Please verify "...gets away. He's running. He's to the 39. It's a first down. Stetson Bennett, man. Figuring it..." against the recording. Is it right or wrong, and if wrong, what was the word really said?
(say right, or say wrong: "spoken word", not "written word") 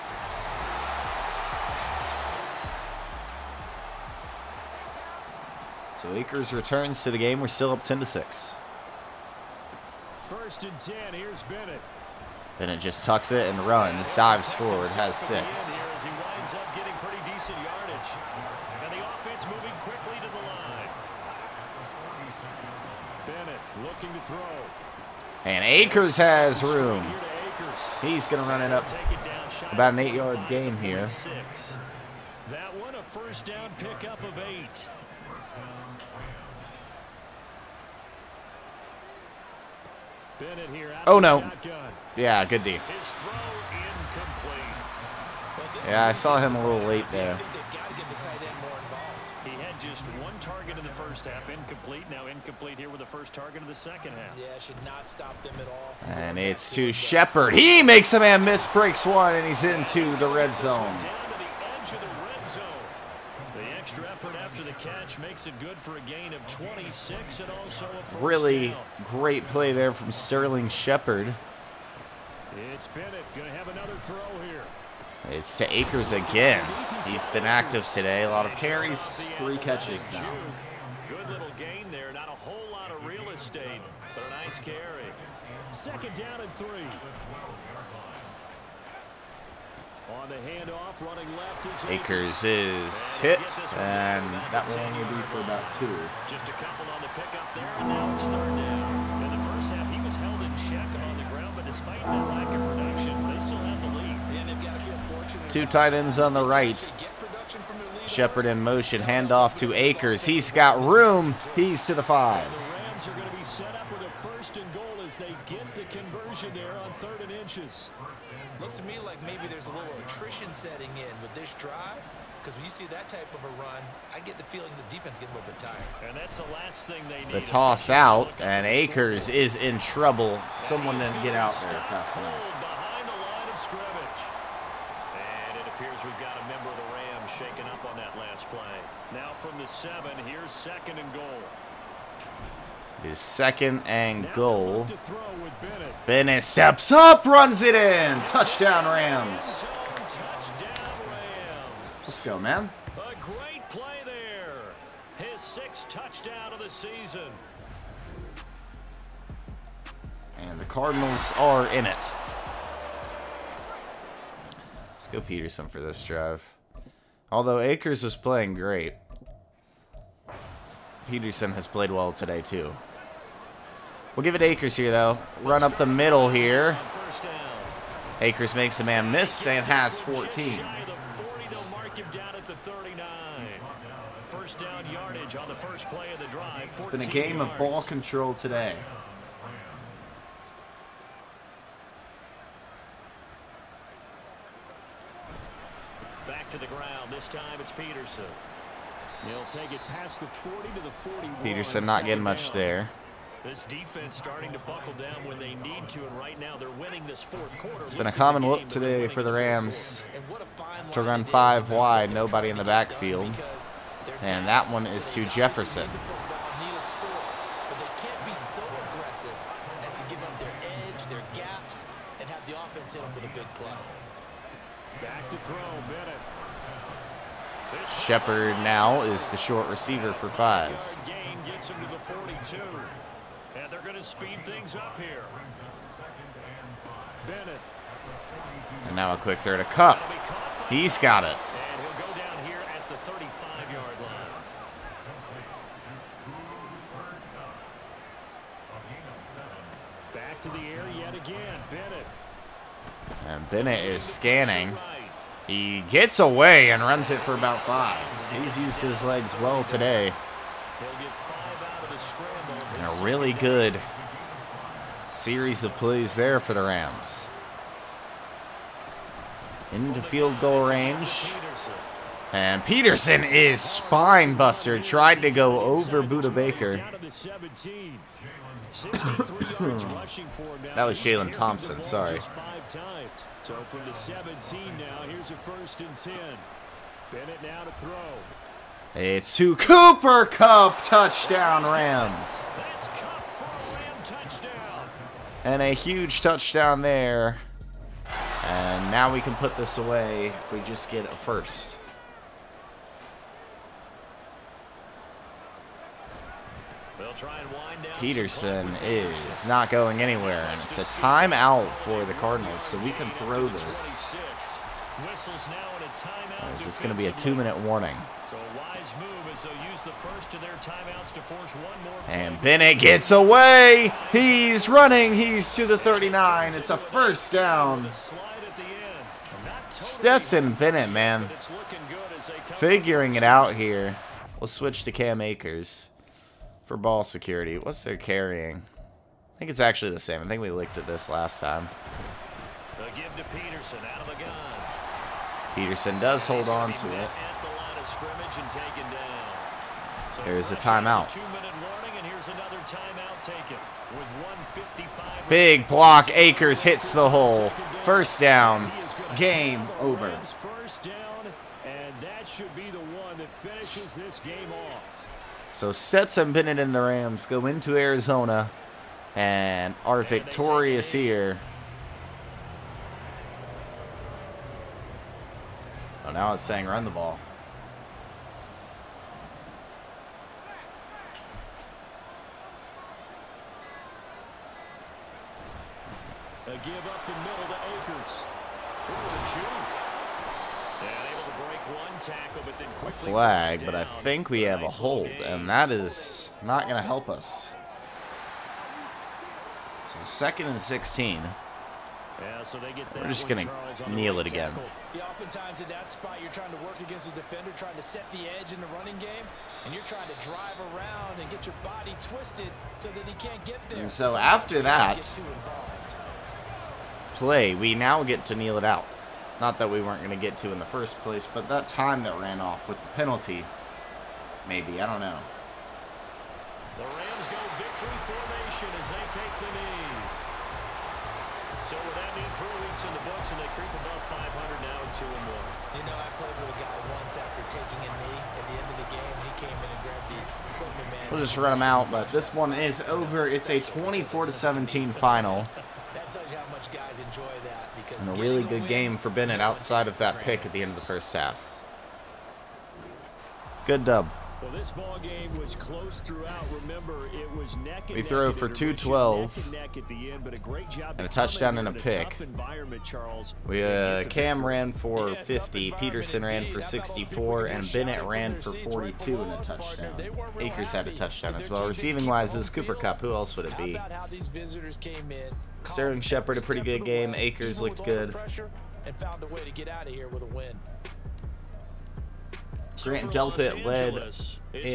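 right.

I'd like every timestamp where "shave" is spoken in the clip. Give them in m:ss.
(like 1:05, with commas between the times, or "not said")
not said.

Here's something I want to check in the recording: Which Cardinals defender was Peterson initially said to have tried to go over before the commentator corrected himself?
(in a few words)
Budda Baker.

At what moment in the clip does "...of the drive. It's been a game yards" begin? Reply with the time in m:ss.
3:06.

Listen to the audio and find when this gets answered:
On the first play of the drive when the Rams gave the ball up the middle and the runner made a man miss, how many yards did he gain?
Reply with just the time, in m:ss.
2:59.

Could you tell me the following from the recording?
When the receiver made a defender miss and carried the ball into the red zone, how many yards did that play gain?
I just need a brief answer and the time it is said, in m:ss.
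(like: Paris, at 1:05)
26, at 1:05.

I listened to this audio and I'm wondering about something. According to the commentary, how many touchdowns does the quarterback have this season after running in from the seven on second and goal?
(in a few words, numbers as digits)
6.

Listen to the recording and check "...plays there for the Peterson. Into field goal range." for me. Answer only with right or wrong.
wrong.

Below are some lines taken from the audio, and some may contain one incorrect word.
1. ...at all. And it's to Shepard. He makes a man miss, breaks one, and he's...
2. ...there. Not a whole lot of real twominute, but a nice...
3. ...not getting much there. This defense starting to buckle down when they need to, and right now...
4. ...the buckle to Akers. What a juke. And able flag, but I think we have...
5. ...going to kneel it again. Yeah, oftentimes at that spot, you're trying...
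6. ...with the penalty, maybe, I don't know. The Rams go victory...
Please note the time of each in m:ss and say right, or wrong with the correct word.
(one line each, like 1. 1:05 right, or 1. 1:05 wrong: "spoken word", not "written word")
1. 0:55 right
2. 1:21 wrong: "estate", not "twominute"
3. 3:21 right
4. 6:27 wrong: "middle", not "buckle"
5. 6:43 right
6. 7:02 right.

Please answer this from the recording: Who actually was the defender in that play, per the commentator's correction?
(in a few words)
Jalen Thompson.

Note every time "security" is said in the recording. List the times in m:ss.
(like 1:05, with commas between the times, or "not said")
5:37.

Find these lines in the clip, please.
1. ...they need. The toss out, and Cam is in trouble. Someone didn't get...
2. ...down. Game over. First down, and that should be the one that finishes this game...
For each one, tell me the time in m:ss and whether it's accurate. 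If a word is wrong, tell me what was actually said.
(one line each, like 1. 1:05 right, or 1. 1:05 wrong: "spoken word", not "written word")
1. 2:07 wrong: "Akers", not "Cam"
2. 5:58 right.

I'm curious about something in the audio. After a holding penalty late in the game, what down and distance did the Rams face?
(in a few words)
second and 16.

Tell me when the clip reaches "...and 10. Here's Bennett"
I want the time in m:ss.
0:10.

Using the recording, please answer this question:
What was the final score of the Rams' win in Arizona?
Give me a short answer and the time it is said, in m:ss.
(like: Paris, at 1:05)
24-17, at 7:23.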